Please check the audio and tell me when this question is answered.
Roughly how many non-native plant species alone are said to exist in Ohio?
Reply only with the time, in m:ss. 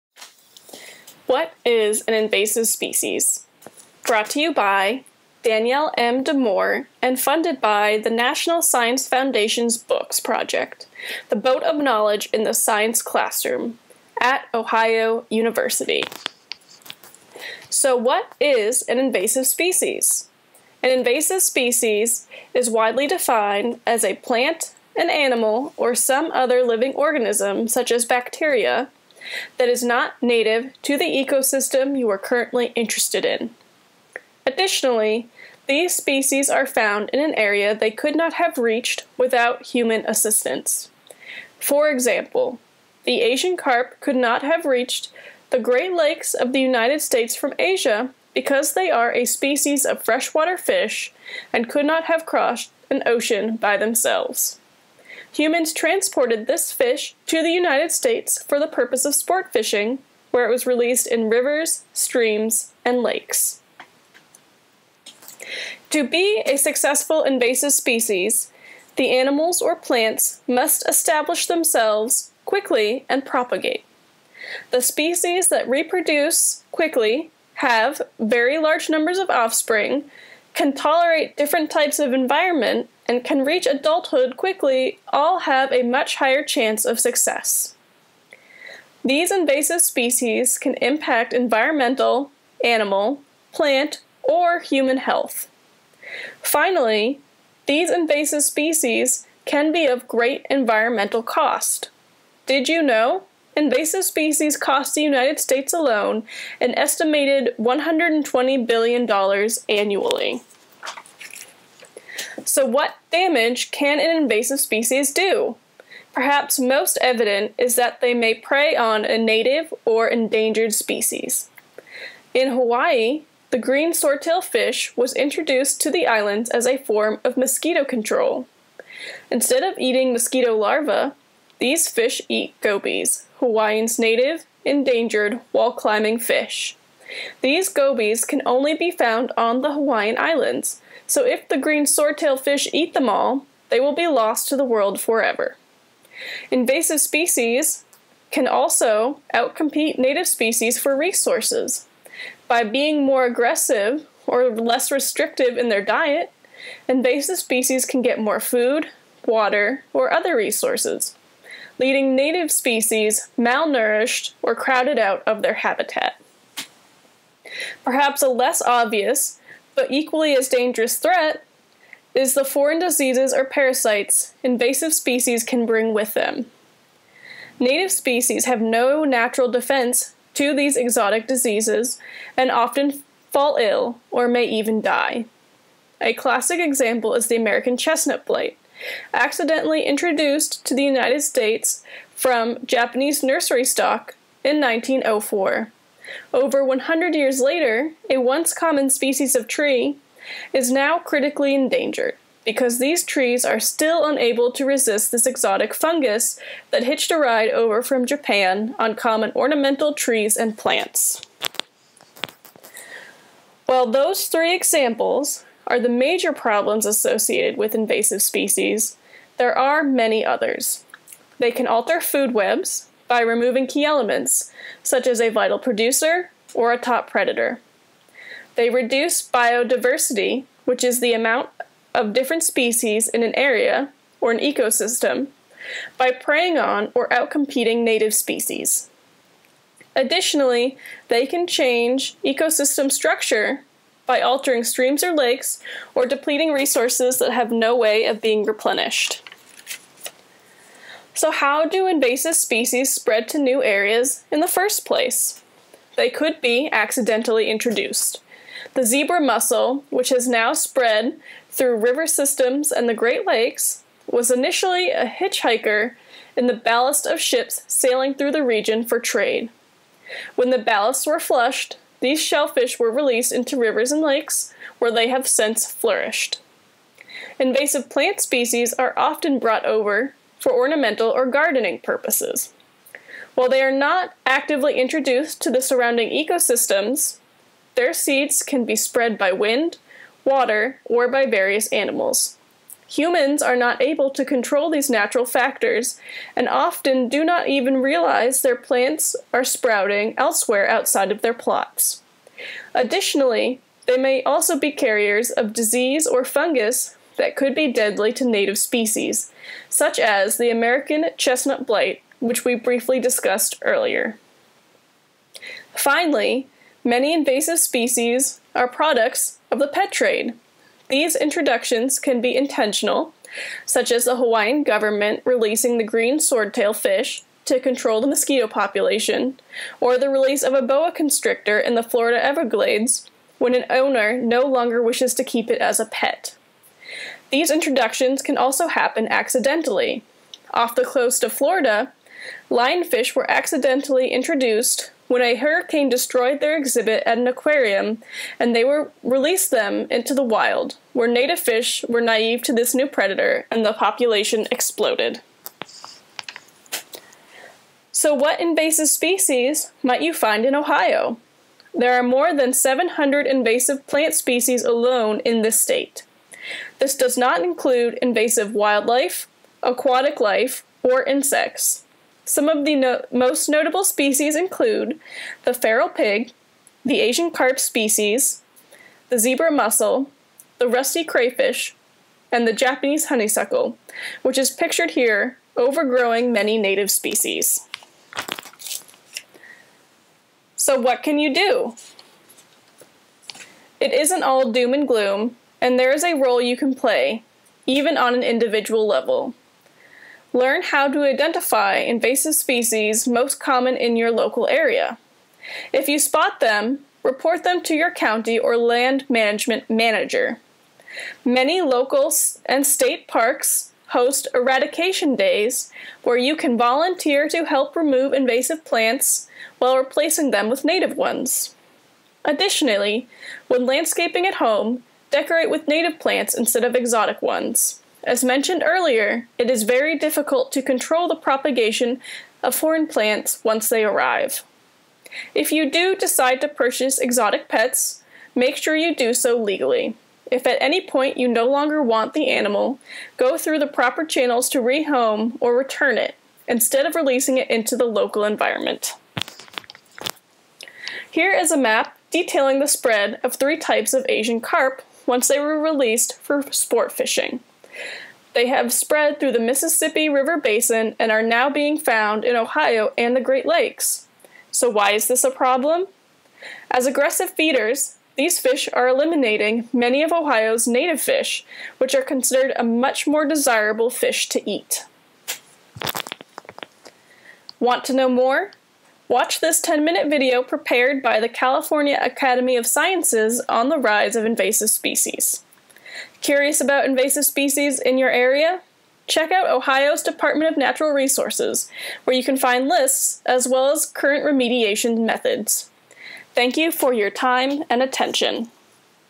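6:02.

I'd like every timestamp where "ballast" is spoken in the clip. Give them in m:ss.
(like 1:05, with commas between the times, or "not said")
4:26, 4:30.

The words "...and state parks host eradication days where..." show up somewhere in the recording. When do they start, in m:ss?
6:52.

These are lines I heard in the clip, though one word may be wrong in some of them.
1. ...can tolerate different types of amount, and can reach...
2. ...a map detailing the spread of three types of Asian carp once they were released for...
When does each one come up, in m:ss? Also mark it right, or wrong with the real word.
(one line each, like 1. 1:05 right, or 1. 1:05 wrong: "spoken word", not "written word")
1. 1:20 wrong: "environment", not "amount"
2. 7:31 right.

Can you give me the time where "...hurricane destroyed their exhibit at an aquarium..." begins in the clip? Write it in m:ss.
5:45.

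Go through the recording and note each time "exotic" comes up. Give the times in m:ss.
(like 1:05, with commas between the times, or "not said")
3:00, 3:25, 7:06, 7:16.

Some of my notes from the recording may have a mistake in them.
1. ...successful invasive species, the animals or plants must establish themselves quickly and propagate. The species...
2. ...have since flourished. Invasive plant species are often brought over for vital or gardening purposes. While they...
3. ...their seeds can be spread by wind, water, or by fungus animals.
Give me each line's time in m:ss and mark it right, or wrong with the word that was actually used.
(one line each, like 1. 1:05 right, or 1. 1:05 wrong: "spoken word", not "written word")
1. 1:06 right
2. 4:35 wrong: "ornamental", not "vital"
3. 4:47 wrong: "various", not "fungus".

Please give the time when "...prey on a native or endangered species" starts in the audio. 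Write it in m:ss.
1:58.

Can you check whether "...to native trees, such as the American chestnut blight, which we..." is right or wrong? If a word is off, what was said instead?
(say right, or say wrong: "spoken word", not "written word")
wrong: "species", not "trees".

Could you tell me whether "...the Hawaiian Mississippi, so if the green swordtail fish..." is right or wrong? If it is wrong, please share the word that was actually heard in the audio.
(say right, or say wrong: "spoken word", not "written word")
wrong: "Islands", not "Mississippi".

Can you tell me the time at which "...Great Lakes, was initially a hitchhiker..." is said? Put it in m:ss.
4:23.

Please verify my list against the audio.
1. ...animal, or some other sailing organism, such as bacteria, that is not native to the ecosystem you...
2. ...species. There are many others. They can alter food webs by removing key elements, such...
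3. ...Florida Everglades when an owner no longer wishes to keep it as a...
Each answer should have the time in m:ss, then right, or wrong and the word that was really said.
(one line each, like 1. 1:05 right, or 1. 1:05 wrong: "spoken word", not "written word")
1. 0:25 wrong: "living", not "sailing"
2. 3:38 right
3. 5:31 right.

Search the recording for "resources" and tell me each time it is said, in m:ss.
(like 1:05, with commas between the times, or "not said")
2:30, 2:40, 4:06, 8:10.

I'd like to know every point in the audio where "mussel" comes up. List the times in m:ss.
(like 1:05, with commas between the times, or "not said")
4:19, 6:19.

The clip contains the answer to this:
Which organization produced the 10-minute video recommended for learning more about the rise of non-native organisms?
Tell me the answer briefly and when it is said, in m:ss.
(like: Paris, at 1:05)
California Academy of Sciences, at 8:01.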